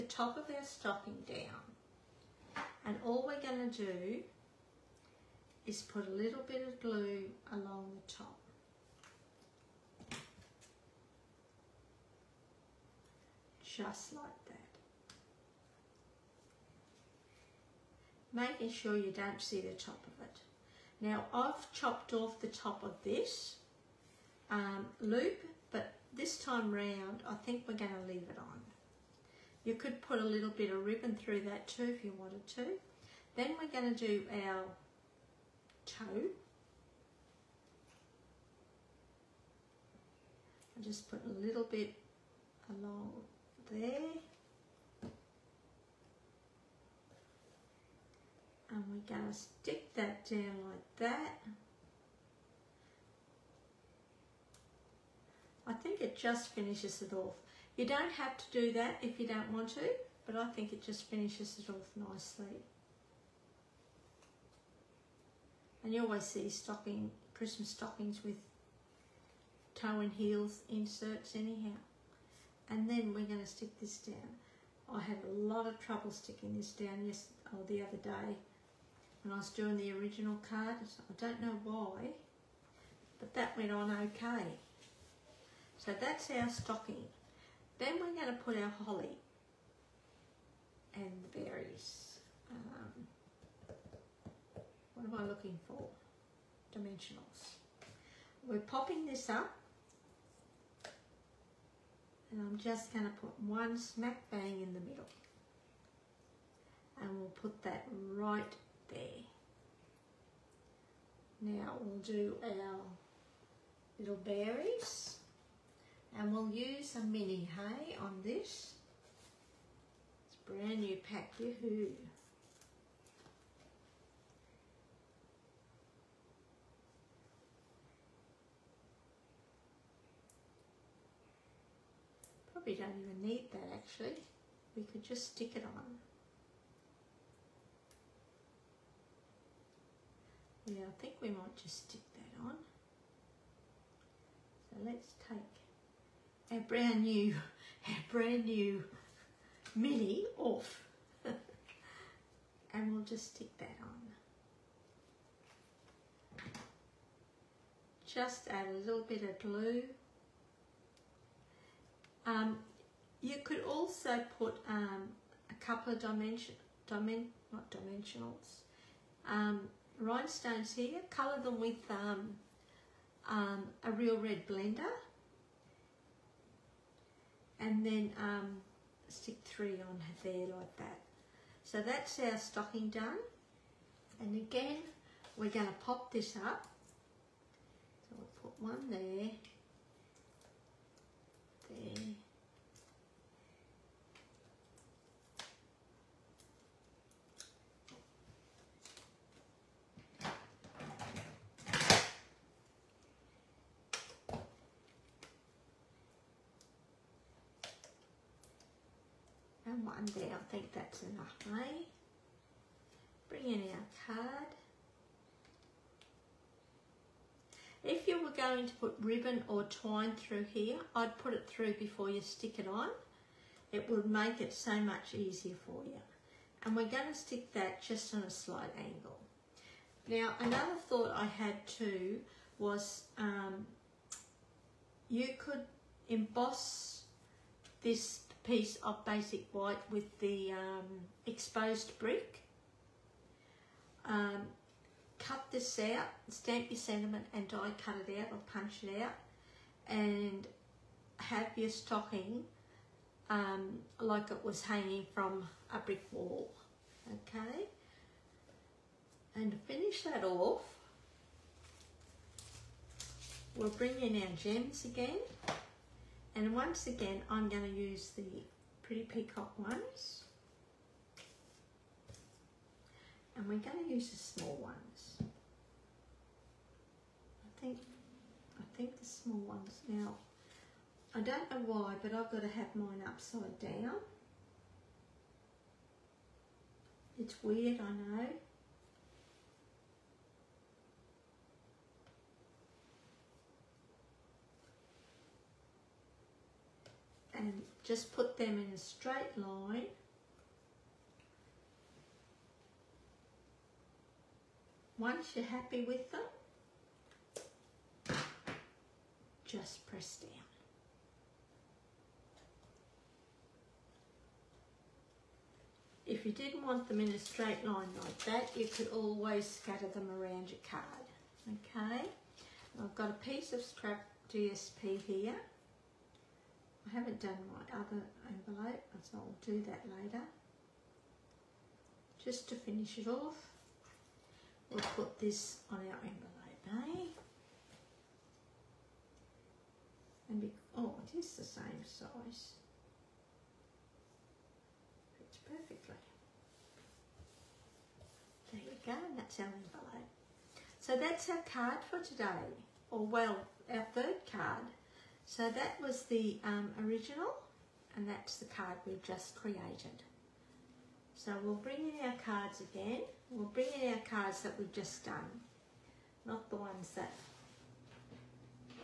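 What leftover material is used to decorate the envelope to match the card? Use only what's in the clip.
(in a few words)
Scrap DSP.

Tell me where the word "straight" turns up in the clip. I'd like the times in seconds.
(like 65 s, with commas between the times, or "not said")
298 s, 317 s.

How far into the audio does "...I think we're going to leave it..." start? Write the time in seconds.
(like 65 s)
27 s.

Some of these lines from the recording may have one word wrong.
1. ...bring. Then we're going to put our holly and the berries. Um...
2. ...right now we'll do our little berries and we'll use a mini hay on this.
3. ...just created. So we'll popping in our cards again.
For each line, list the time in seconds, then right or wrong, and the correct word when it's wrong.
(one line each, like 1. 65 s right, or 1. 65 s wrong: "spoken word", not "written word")
1. 86 s wrong: "stocking", not "bring"
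2. 108 s right
3. 359 s wrong: "bring", not "popping".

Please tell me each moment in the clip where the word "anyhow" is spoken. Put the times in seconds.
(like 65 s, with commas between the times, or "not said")
71 s.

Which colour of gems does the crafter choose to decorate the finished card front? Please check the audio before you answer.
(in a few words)
Pretty Peacock.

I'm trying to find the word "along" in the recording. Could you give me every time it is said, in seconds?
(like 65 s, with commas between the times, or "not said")
7 s, 42 s.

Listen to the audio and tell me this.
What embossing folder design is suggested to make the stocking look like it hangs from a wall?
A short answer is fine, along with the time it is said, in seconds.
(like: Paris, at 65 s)
Exposed brick, at 241 s.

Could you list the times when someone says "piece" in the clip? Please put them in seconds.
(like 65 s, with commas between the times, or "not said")
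238 s, 323 s.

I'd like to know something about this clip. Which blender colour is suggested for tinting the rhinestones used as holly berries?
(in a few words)
Real red.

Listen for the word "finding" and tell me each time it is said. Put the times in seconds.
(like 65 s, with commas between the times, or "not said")
not said.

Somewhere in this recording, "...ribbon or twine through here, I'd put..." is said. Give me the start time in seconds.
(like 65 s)
219 s.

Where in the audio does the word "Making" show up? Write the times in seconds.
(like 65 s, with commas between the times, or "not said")
18 s.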